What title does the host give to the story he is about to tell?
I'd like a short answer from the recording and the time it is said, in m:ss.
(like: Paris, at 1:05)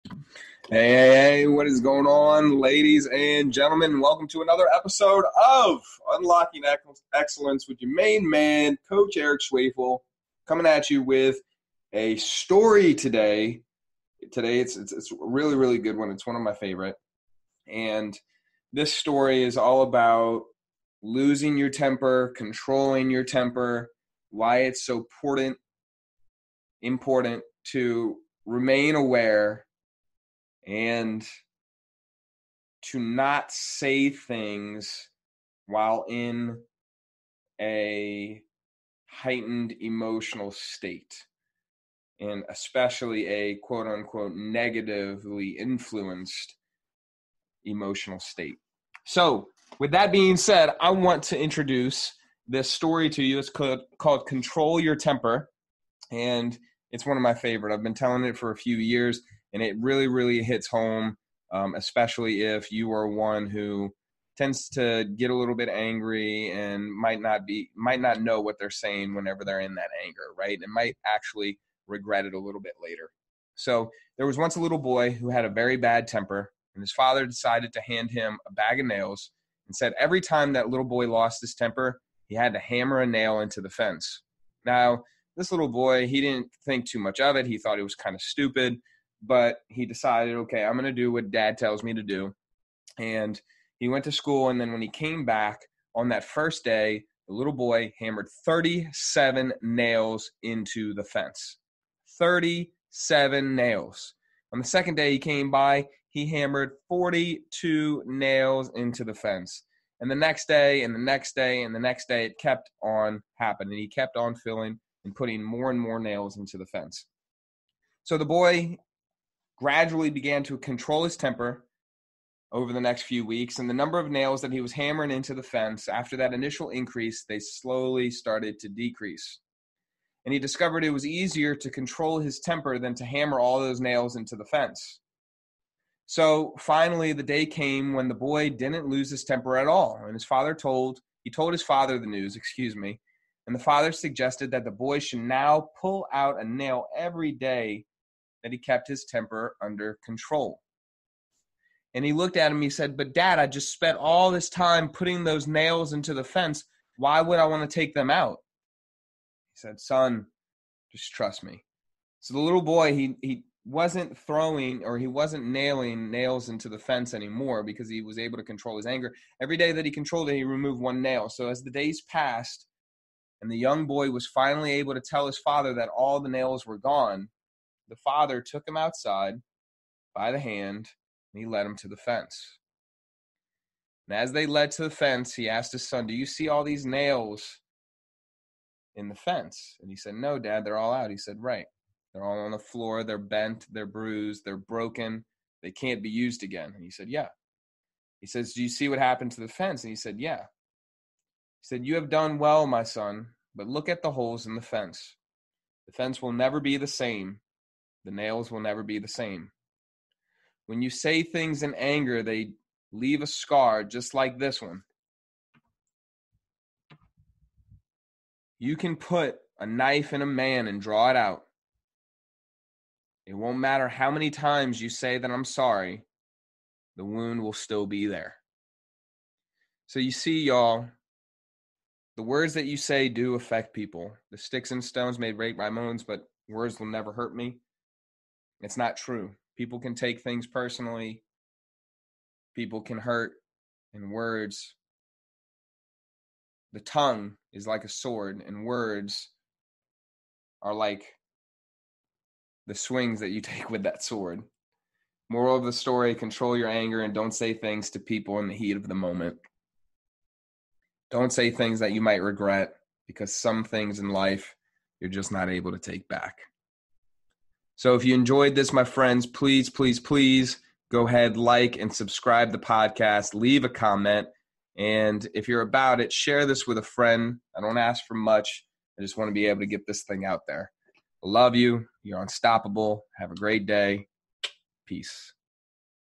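Control Your Temper, at 0:54.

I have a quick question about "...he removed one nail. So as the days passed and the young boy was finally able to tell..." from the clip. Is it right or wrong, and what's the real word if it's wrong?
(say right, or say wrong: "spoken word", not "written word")
right.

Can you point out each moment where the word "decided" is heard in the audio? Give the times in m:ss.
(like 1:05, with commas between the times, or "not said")
1:17, 1:29.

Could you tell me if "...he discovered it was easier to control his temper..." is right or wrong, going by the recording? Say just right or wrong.
right.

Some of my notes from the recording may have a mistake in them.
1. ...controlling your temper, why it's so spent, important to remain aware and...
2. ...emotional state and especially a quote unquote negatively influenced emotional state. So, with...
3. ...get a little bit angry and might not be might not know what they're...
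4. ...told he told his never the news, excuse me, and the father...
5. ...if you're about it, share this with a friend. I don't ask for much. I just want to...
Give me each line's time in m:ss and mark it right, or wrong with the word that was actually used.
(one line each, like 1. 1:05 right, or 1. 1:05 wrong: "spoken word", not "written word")
1. 0:22 wrong: "important", not "spent"
2. 0:39 right
3. 1:05 right
4. 2:20 wrong: "father", not "never"
5. 4:35 right.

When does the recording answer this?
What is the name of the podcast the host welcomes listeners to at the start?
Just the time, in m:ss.
0:06.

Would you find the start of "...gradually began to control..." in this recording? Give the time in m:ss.
1:59.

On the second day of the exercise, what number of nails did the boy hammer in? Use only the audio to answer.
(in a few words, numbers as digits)
42.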